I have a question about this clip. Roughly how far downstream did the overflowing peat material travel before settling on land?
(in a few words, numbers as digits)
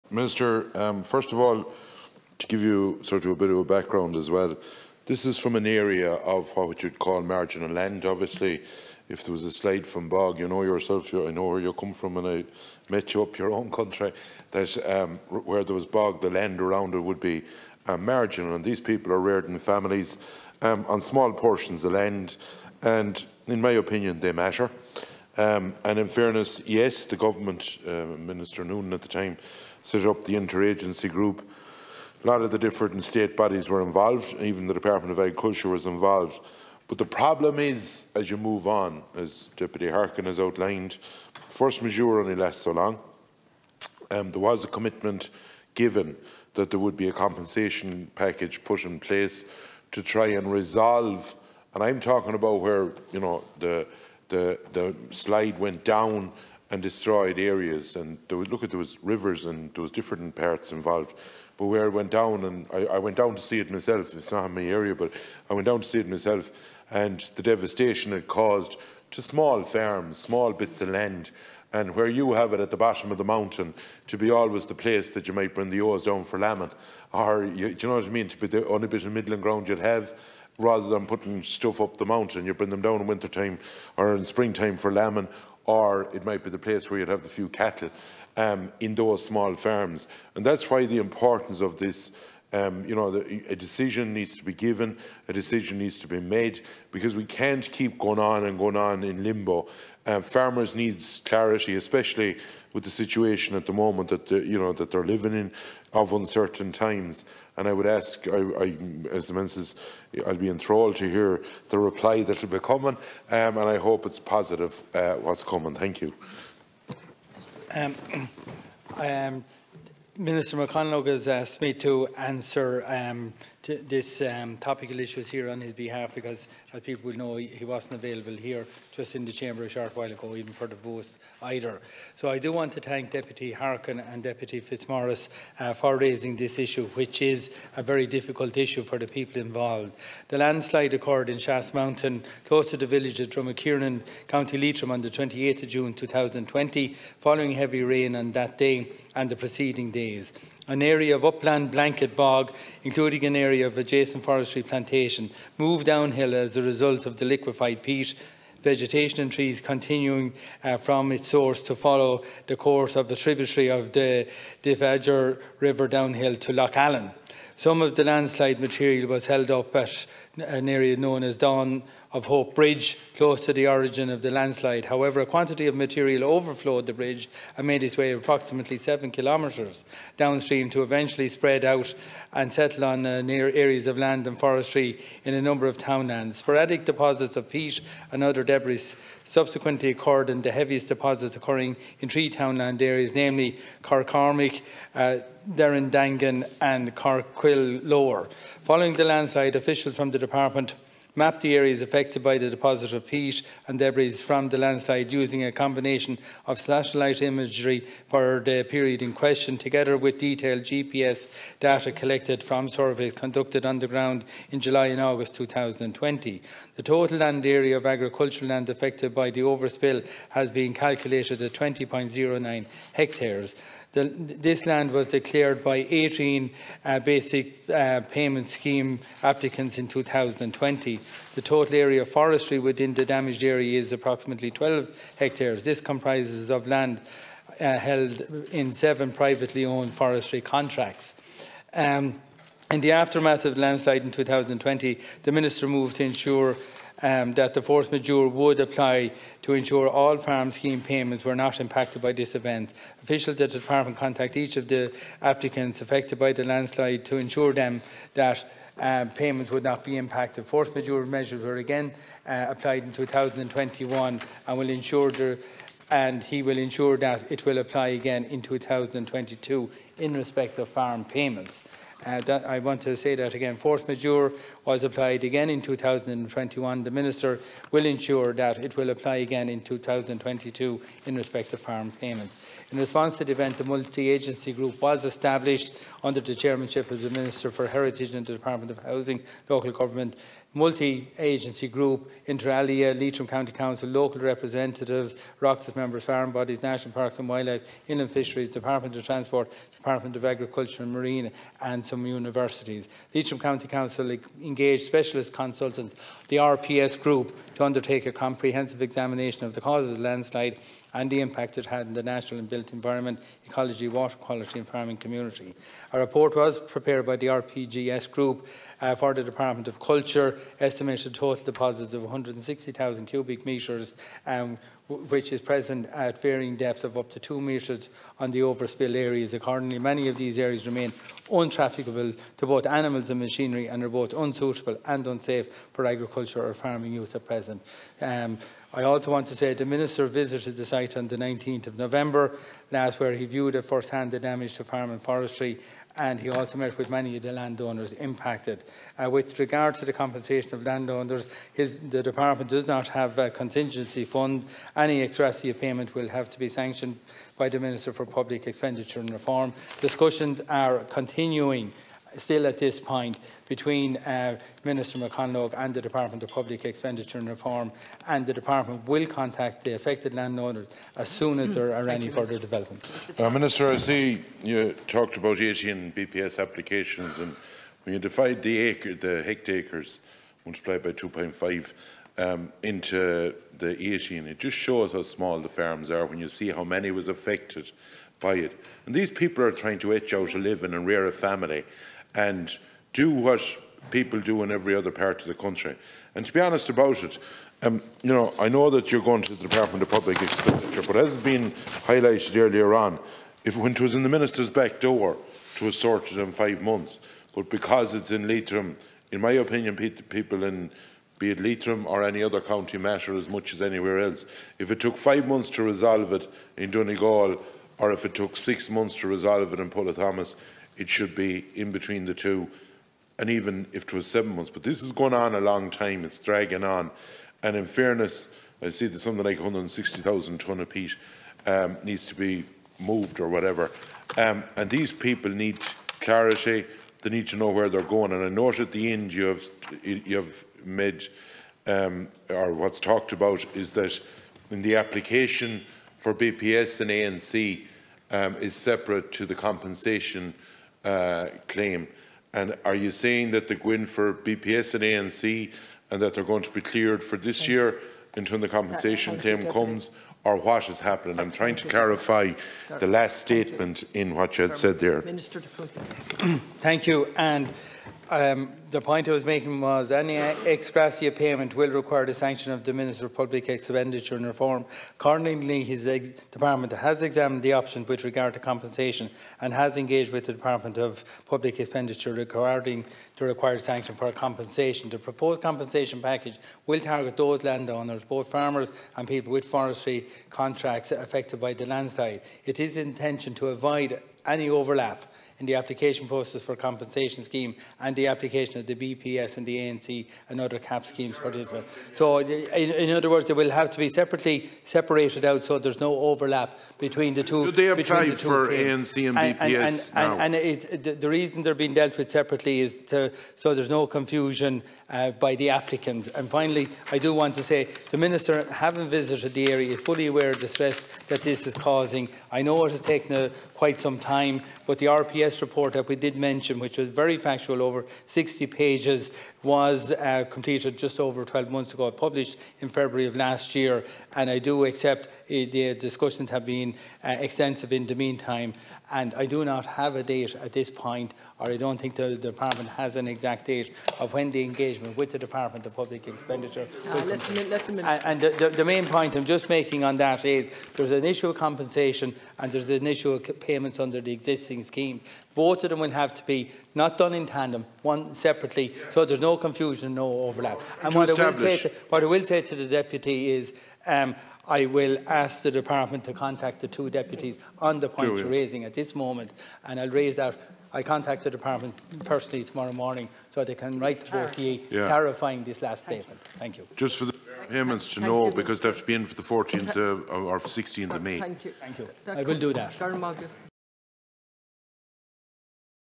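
7 kilometres.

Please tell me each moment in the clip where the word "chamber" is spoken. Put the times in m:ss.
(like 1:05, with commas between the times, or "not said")
2:09.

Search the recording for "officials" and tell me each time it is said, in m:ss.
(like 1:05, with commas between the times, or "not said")
3:19, 4:13.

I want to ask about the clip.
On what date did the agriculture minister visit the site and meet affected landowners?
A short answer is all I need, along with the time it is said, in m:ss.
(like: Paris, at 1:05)
19 November, at 5:41.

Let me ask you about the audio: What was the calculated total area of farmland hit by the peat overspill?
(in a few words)
20.09 hectares.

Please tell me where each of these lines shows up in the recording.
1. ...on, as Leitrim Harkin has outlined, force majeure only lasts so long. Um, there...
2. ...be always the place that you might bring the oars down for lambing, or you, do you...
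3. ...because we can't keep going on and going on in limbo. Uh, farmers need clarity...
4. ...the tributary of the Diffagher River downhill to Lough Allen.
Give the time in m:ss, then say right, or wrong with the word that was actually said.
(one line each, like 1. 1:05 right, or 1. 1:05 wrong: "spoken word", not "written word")
1. 0:38 wrong: "Deputy", not "Leitrim"
2. 1:14 right
3. 1:36 right
4. 2:43 right.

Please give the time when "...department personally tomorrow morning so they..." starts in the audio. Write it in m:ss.
9:31.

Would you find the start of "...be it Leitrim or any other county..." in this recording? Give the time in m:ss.
6:51.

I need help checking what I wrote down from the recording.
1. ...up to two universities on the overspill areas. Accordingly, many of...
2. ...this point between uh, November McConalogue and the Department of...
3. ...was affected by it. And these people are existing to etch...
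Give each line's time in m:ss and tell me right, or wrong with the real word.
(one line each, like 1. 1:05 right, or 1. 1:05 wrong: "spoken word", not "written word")
1. 5:26 wrong: "metres", not "universities"
2. 6:02 wrong: "Minister", not "November"
3. 6:26 wrong: "trying", not "existing".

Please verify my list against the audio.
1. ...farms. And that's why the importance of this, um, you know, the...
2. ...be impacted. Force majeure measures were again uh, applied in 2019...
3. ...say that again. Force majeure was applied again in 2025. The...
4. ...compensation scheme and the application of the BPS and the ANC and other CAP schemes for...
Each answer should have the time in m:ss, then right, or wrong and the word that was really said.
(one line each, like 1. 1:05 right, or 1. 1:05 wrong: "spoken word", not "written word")
1. 1:29 right
2. 4:19 wrong: "2021", not "2019"
3. 4:32 wrong: "2021", not "2025"
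4. 8:16 right.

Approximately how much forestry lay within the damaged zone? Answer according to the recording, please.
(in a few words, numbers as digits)
12 hectares.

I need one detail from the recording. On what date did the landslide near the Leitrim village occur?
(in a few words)
28 June 2020.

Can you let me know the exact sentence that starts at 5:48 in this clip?
Uh, with regard to the compensation of landowners, his, the department does not have a contingency fund.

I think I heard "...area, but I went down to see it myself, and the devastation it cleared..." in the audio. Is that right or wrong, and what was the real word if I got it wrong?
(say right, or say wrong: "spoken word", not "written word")
wrong: "caused", not "cleared".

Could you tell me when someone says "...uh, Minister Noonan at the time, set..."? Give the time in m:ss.
0:27.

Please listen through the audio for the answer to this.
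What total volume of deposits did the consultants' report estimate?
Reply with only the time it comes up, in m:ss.
5:22.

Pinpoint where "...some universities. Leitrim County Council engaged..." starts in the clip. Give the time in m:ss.
5:01.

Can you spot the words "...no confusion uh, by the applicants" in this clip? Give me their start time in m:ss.
8:33.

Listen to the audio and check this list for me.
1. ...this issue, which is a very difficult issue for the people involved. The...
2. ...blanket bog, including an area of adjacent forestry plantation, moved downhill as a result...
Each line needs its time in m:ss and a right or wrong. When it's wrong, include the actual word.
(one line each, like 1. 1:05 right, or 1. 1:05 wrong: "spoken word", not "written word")
1. 2:16 right
2. 2:31 right.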